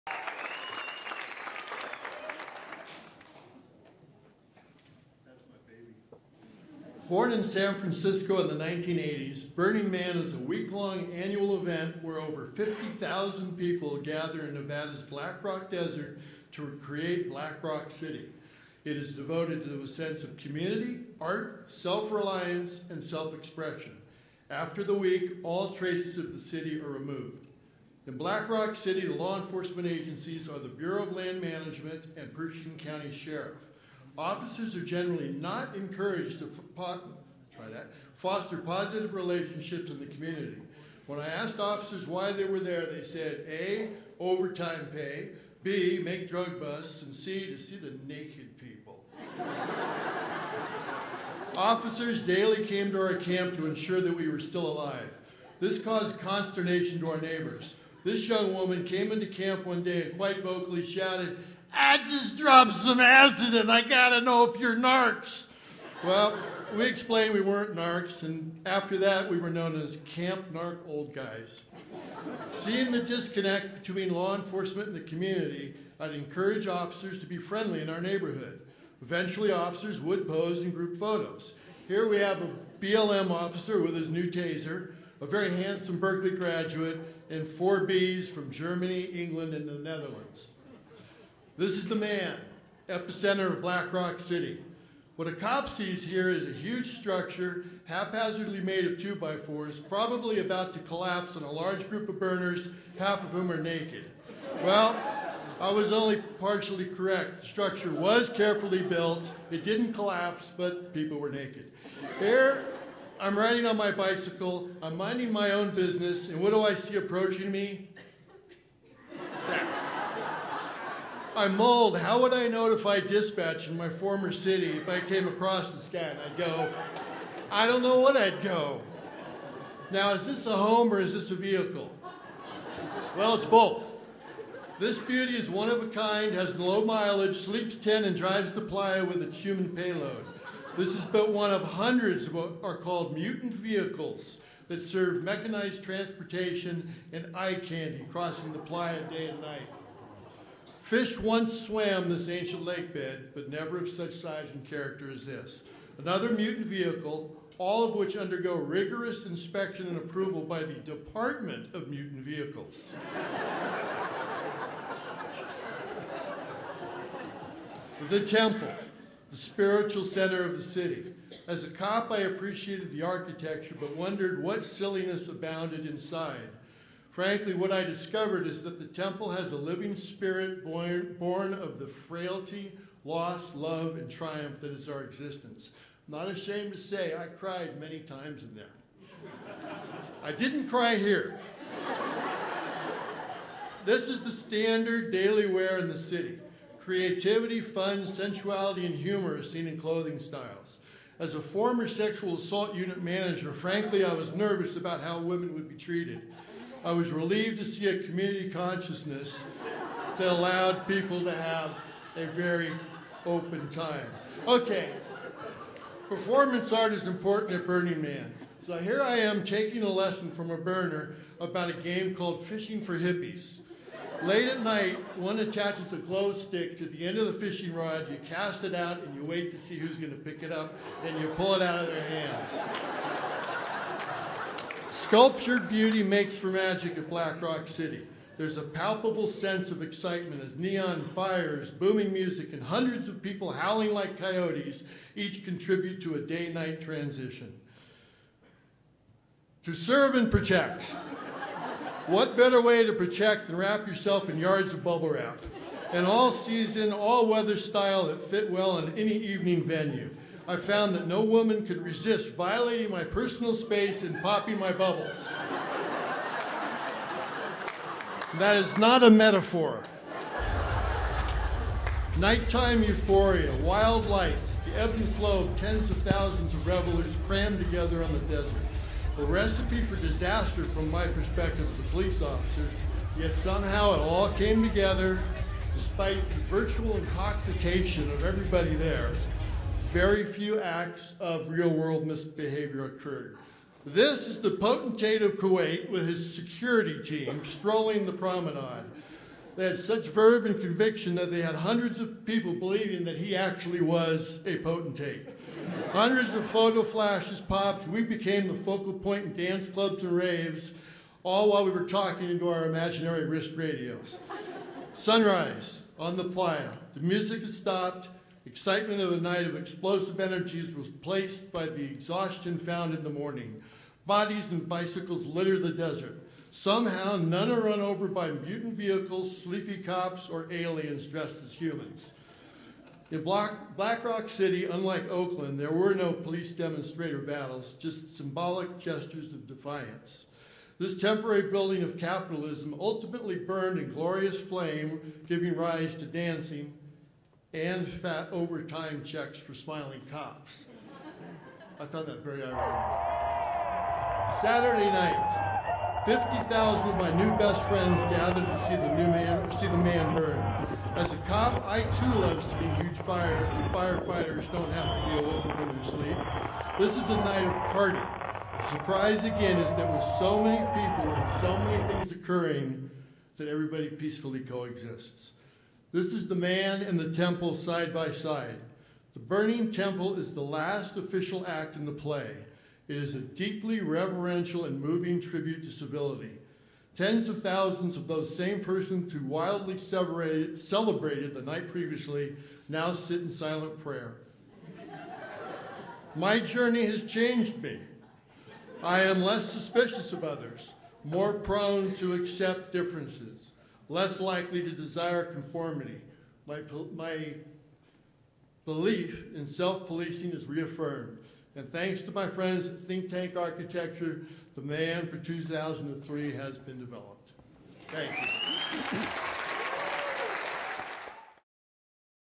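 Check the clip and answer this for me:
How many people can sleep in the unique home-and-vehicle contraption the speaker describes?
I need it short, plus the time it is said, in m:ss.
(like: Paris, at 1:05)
10, at 2:17.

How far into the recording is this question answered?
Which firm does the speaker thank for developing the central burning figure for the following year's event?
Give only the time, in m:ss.
6:52.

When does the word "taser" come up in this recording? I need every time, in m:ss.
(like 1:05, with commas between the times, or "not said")
1:24.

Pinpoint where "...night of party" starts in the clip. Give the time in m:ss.
6:07.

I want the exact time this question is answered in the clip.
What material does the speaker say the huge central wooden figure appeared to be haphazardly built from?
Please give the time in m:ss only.
1:38.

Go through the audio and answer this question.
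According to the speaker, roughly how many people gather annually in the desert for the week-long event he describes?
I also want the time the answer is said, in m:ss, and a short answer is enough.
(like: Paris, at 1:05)
over 50,000, at 0:12.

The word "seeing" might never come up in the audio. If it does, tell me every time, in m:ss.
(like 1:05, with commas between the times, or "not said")
1:12, 6:02.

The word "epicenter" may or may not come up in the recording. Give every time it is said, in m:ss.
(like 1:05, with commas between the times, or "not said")
1:32.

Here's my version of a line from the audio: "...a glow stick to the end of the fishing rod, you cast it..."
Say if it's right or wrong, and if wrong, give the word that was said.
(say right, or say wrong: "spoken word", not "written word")
right.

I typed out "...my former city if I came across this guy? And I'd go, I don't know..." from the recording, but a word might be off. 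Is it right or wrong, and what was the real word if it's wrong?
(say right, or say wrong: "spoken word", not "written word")
right.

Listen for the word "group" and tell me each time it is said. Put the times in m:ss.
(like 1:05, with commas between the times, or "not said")
1:20, 1:41.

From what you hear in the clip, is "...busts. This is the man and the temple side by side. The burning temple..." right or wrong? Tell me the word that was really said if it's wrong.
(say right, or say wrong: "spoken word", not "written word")
wrong: "coexists", not "busts".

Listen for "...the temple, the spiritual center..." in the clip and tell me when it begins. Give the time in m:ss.
2:48.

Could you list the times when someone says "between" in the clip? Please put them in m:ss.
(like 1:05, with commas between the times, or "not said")
1:13.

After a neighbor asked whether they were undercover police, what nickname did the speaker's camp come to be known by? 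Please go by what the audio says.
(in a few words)
Camp Narc Old Guys.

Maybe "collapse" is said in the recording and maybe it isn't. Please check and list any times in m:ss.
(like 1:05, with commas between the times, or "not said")
1:40, 1:49.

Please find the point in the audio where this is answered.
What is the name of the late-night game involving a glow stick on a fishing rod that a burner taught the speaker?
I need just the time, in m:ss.
3:42.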